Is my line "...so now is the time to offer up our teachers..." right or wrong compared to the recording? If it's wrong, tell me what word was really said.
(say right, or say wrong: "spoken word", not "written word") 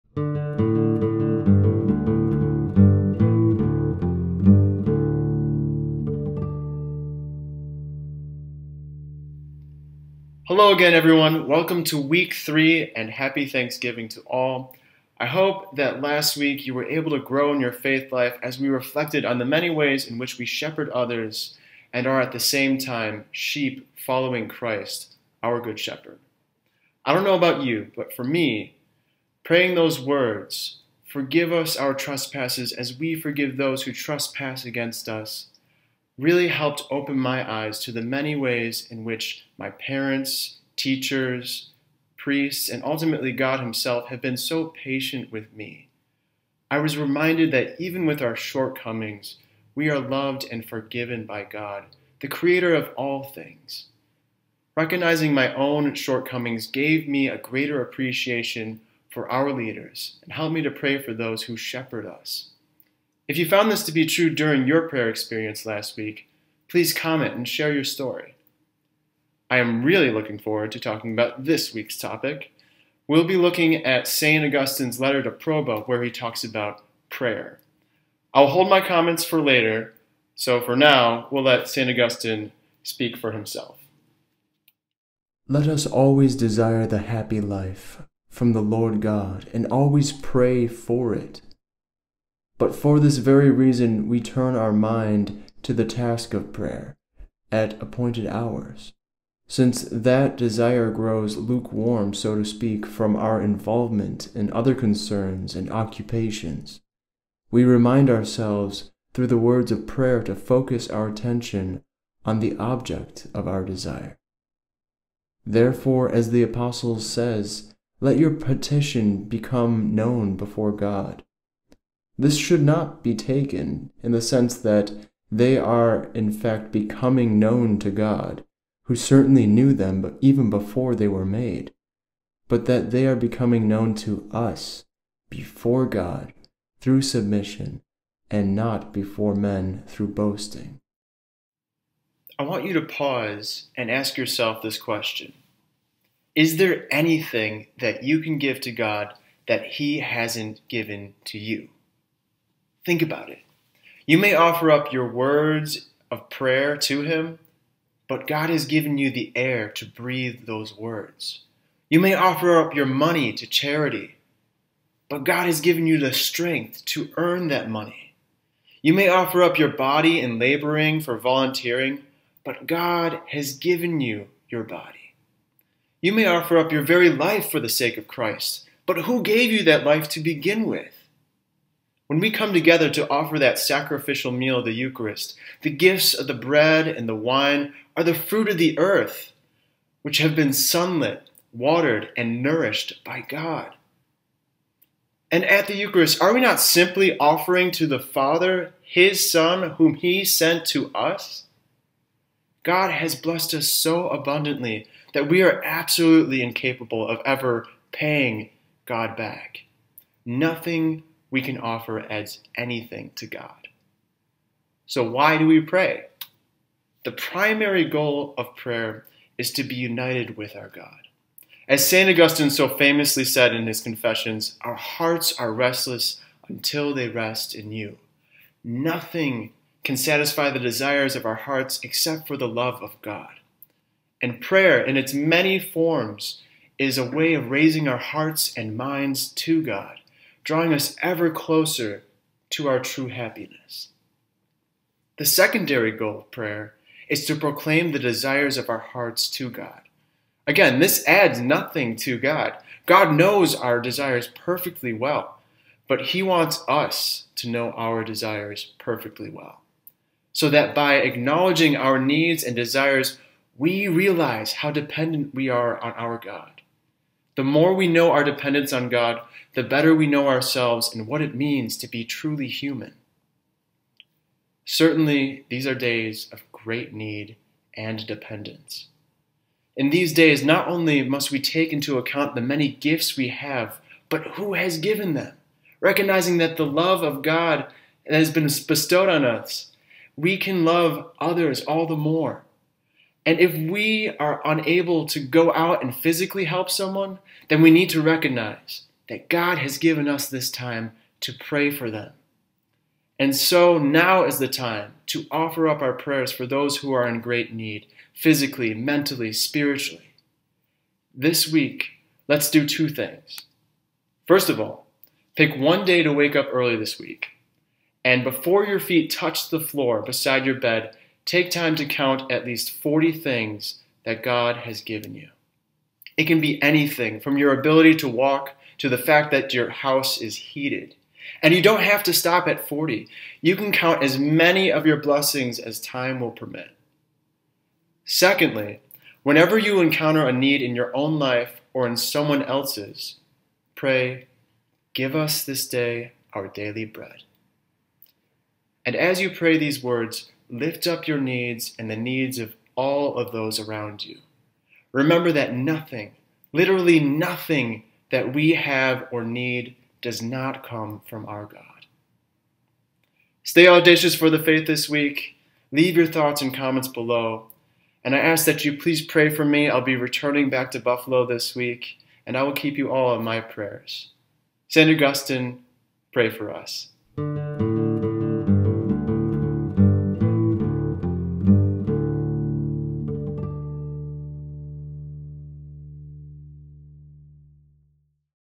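wrong: "prayers", not "teachers".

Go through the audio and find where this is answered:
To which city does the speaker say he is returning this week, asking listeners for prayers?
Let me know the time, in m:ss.
6:10.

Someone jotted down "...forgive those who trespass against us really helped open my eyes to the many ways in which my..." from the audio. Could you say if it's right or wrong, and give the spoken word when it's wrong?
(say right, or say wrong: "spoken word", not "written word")
right.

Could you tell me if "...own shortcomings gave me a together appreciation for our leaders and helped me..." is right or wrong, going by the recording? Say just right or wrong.
wrong.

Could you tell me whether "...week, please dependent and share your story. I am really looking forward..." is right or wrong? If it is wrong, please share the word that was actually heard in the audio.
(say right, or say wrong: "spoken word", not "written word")
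wrong: "comment", not "dependent".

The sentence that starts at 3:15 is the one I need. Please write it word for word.
And at the Eucharist, are we not simply offering to the Father His Son, whom He sent to us?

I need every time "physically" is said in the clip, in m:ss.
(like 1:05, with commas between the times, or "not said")
4:55, 5:08.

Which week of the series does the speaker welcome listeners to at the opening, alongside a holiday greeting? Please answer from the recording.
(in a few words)
Week 3.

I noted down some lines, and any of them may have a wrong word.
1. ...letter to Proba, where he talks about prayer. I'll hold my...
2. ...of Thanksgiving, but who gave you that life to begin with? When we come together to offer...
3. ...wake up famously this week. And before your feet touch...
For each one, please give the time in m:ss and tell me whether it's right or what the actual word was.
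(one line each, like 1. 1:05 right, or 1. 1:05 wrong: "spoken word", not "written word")
1. 1:14 right
2. 2:57 wrong: "Christ", not "Thanksgiving"
3. 5:16 wrong: "early", not "famously".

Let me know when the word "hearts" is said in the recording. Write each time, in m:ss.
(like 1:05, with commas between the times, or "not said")
3:44, 3:51, 3:57, 4:08.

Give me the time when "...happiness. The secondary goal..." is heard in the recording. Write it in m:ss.
4:03.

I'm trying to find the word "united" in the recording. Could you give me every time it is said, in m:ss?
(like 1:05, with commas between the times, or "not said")
3:39.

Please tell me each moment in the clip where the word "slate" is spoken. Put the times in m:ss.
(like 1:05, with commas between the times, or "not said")
not said.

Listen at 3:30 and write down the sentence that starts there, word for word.
Nothing we can offer as anything to God.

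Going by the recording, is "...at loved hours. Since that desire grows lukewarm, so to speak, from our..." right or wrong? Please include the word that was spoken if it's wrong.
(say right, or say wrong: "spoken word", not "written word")
wrong: "appointed", not "loved".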